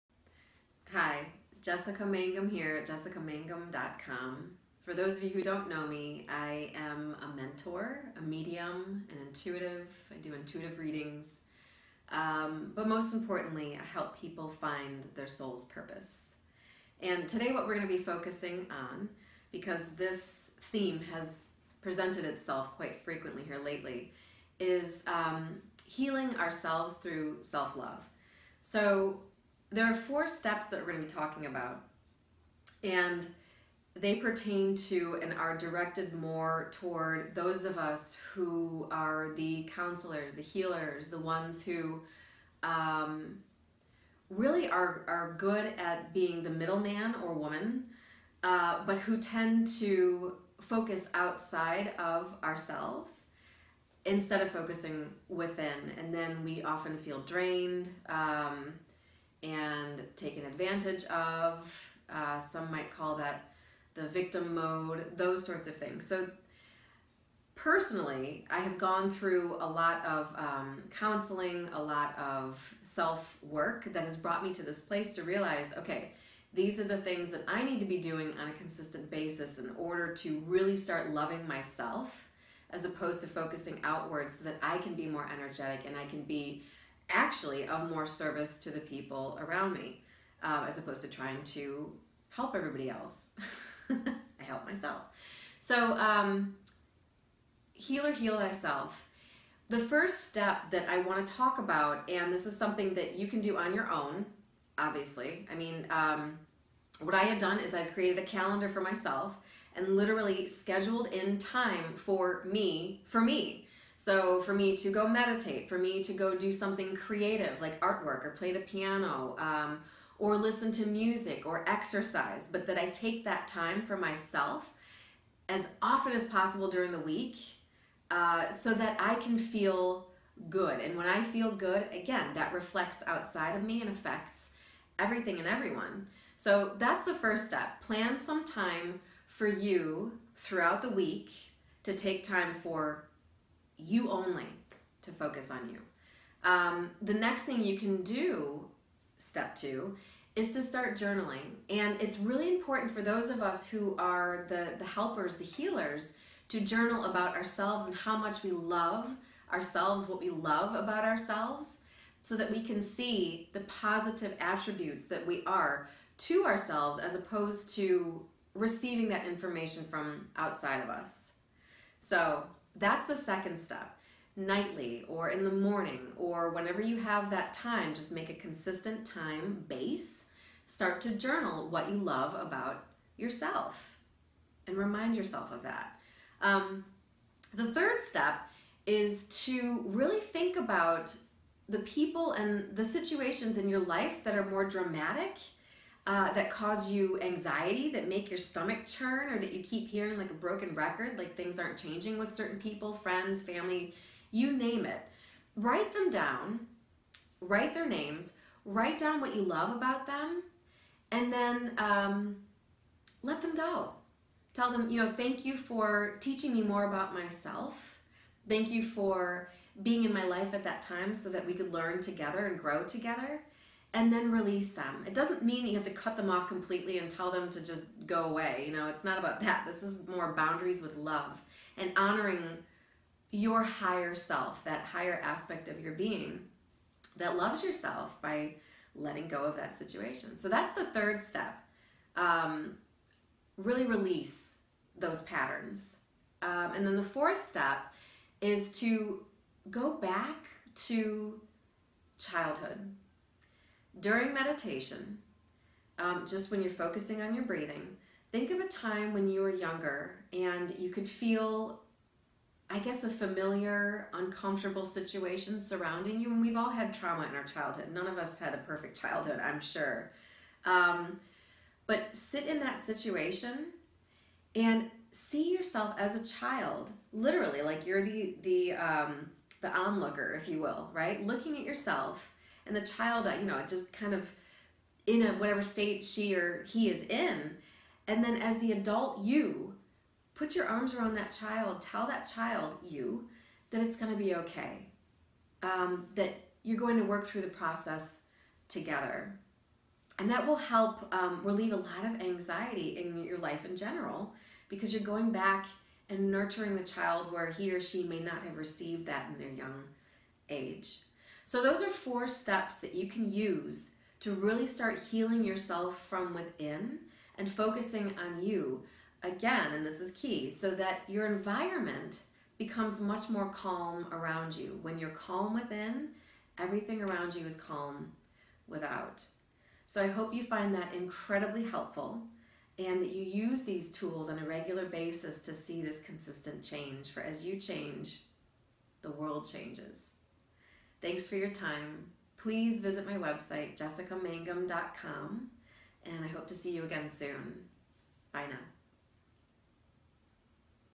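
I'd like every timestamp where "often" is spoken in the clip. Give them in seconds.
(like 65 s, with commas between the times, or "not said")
56 s, 125 s.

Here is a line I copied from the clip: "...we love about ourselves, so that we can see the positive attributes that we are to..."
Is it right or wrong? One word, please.
right.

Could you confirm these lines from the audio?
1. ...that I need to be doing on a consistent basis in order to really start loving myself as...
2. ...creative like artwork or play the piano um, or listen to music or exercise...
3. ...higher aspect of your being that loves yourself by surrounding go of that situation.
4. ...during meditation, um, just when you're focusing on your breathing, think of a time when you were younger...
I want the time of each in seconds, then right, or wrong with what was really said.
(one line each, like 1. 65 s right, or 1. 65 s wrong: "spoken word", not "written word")
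1. 77 s right
2. 116 s right
3. 234 s wrong: "letting", not "surrounding"
4. 253 s right.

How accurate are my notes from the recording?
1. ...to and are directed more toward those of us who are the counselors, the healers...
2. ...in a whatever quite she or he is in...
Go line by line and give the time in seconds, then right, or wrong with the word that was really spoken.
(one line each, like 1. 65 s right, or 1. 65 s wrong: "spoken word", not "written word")
1. 34 s right
2. 285 s wrong: "state", not "quite".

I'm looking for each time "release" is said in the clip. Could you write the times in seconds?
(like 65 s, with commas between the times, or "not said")
224 s, 243 s.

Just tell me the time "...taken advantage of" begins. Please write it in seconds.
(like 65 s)
60 s.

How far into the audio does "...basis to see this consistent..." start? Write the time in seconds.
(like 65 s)
334 s.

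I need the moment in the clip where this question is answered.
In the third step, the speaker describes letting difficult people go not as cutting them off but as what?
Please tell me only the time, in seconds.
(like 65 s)
230 s.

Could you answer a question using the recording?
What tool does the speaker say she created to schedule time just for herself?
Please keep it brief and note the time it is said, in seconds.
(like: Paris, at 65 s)
A calendar, at 108 s.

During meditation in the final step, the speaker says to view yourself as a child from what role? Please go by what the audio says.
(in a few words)
The onlooker.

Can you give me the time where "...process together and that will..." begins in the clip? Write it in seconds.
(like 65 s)
297 s.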